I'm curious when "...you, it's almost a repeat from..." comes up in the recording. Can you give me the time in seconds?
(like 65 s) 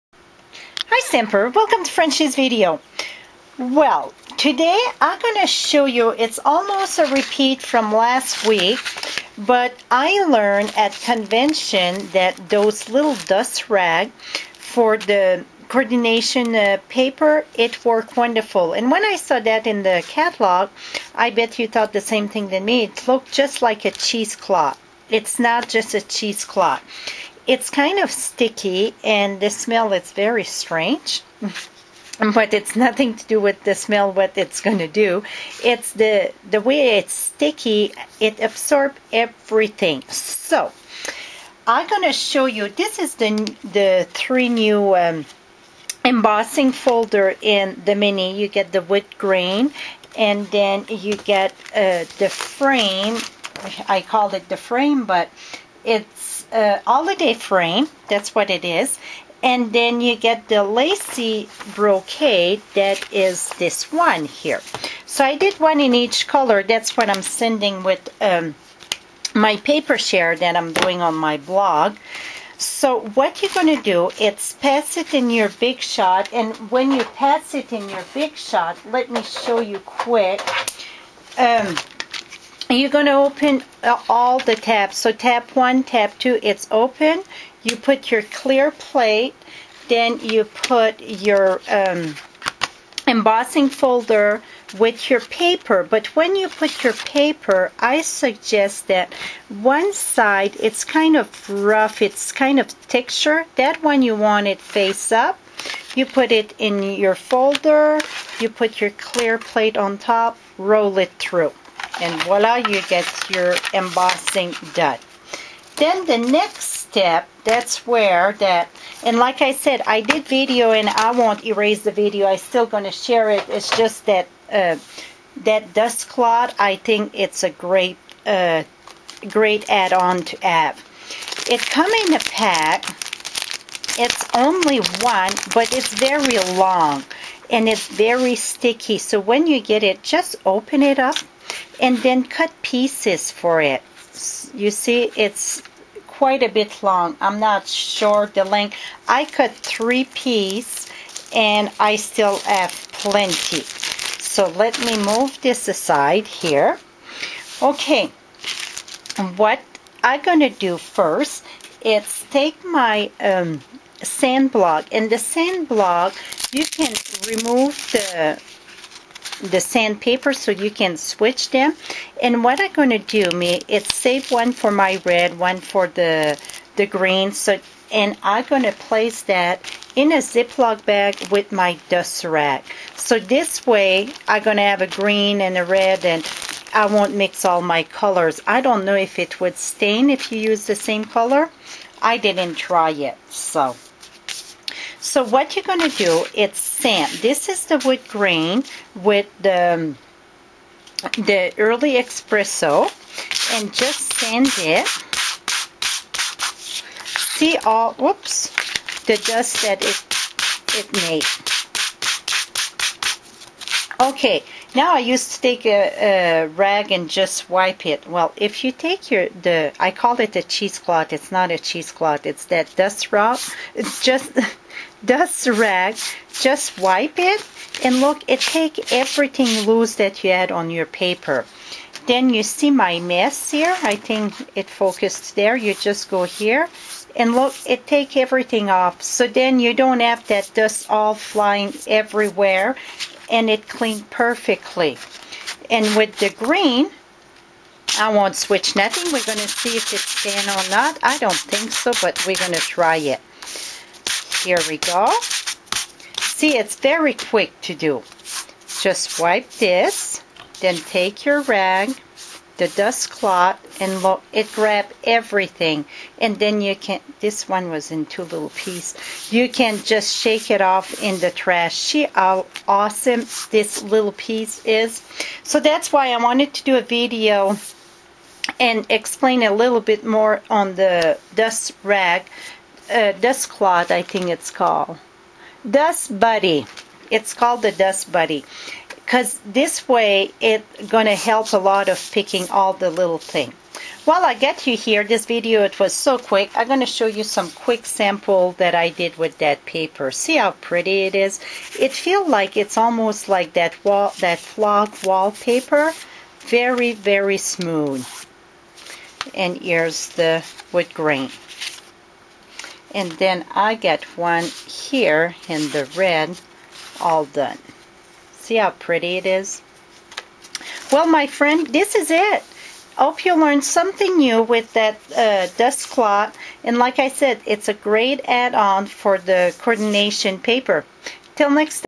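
5 s.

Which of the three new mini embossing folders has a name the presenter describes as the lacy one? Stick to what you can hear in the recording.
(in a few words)
Brocade.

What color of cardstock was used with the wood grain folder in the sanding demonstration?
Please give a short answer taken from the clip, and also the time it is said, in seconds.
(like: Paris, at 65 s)
Early Espresso, at 201 s.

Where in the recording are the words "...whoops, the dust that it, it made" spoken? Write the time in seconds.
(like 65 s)
207 s.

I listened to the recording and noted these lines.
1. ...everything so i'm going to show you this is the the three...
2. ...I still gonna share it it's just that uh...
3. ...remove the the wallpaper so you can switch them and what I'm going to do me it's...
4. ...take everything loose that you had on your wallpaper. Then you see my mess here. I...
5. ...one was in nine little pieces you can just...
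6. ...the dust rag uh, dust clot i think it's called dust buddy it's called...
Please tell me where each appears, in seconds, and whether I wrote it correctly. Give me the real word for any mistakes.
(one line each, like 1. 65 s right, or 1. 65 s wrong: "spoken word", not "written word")
1. 39 s right
2. 122 s right
3. 167 s wrong: "sandpaper", not "wallpaper"
4. 228 s wrong: "paper", not "wallpaper"
5. 267 s wrong: "two", not "nine"
6. 280 s right.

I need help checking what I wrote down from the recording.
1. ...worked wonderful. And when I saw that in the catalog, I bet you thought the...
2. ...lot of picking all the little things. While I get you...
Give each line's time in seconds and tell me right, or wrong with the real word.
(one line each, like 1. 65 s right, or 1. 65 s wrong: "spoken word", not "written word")
1. 17 s right
2. 291 s right.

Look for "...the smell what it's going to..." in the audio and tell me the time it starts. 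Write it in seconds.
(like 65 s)
33 s.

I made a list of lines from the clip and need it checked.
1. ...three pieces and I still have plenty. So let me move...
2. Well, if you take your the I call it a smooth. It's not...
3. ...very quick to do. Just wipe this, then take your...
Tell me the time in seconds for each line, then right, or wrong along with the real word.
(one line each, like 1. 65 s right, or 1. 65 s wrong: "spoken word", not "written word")
1. 149 s right
2. 218 s wrong: "cheesecloth", not "smooth"
3. 256 s right.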